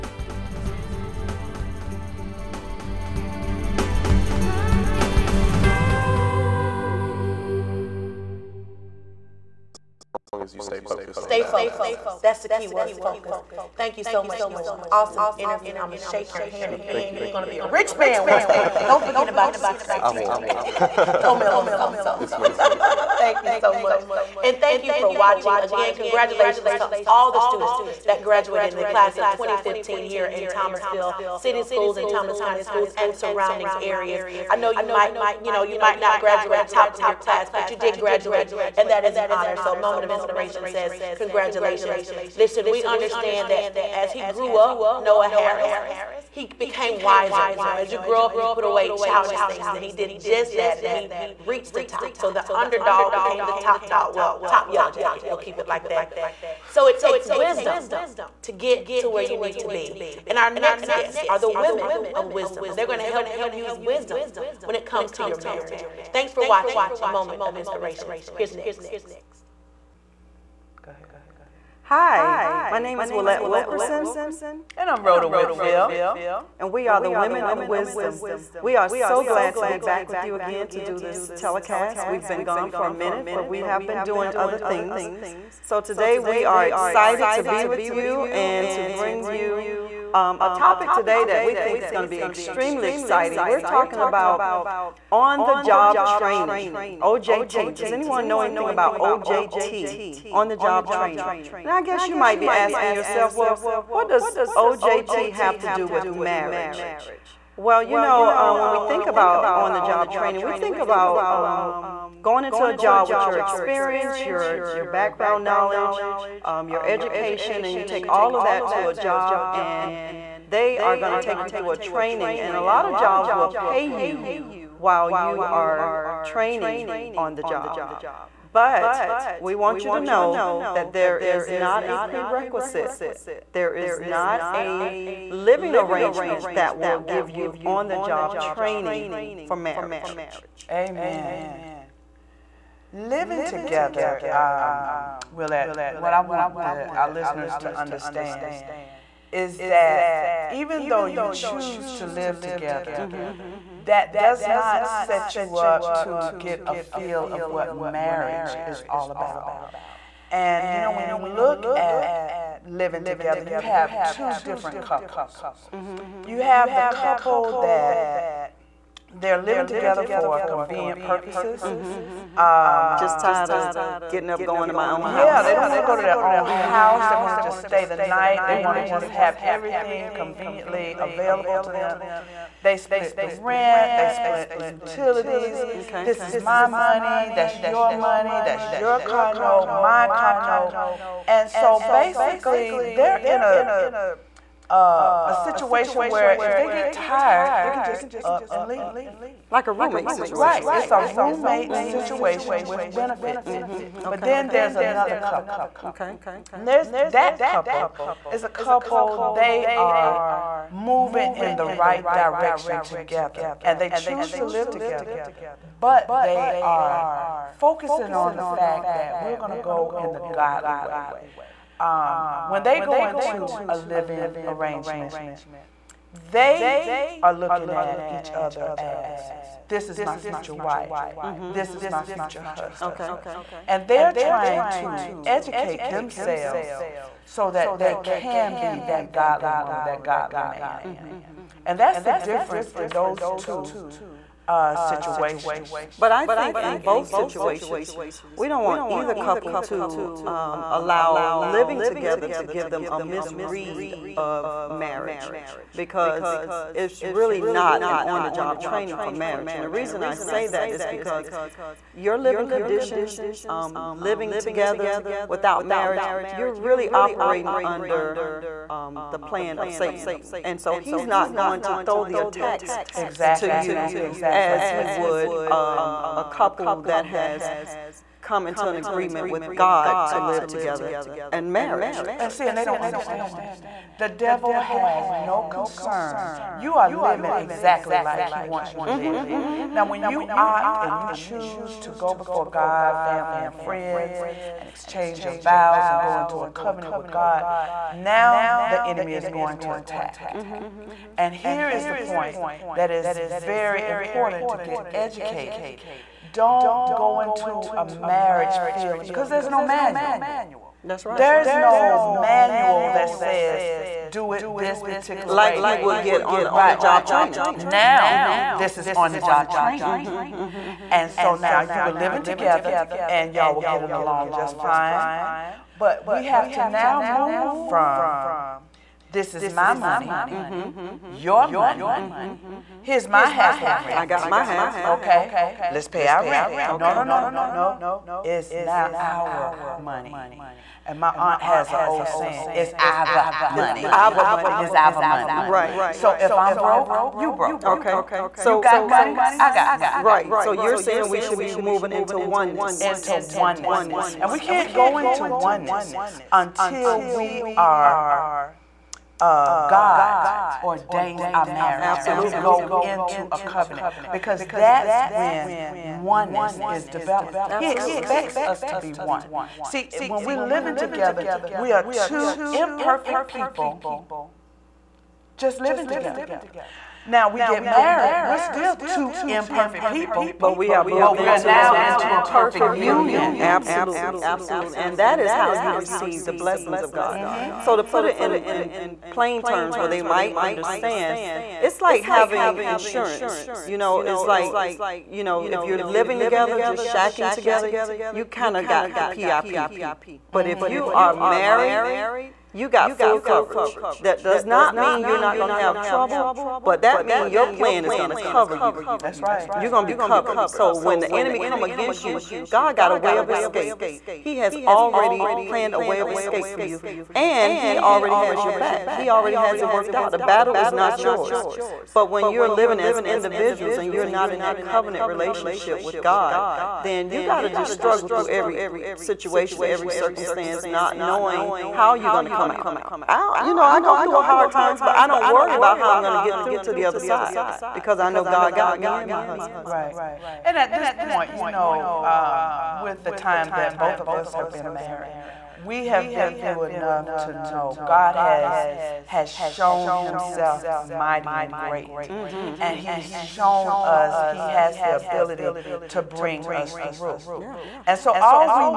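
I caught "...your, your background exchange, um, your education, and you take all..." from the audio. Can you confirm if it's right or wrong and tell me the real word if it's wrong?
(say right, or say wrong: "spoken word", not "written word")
wrong: "knowledge", not "exchange".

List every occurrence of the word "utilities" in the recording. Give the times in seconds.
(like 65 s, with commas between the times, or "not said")
184 s.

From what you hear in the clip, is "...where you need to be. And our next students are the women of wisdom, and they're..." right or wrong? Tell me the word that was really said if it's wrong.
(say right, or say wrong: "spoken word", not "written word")
wrong: "guests", not "students".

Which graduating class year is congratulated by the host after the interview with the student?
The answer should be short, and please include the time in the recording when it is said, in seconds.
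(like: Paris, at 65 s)
2015, at 28 s.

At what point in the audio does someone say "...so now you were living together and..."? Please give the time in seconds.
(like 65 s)
321 s.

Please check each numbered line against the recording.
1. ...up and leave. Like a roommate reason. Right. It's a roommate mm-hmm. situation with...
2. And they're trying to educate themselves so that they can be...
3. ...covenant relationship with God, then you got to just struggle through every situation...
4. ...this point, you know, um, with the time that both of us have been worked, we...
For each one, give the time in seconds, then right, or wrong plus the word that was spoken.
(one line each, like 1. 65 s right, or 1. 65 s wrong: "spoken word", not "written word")
1. 198 s wrong: "situation", not "reason"
2. 233 s right
3. 424 s right
4. 440 s wrong: "married", not "worked".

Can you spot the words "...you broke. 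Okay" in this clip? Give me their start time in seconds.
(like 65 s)
347 s.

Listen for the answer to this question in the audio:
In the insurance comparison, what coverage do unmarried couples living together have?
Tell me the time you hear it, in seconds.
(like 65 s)
398 s.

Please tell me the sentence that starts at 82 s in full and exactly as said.
We've been gone for a minute, but we have been doing other things.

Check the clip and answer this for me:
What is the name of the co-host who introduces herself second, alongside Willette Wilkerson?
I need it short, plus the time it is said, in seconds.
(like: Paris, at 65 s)
Rhoda Whitfield, at 75 s.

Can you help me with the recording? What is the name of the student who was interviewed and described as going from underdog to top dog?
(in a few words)
Noah Harris.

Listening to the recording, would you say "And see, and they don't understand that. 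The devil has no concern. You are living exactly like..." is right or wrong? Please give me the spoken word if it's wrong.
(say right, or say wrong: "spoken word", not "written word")
right.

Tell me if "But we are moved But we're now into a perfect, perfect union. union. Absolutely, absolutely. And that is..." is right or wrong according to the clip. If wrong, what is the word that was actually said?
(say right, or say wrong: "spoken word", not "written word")
right.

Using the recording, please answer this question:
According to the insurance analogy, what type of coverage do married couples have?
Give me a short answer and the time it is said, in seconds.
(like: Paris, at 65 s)
full coverage, at 402 s.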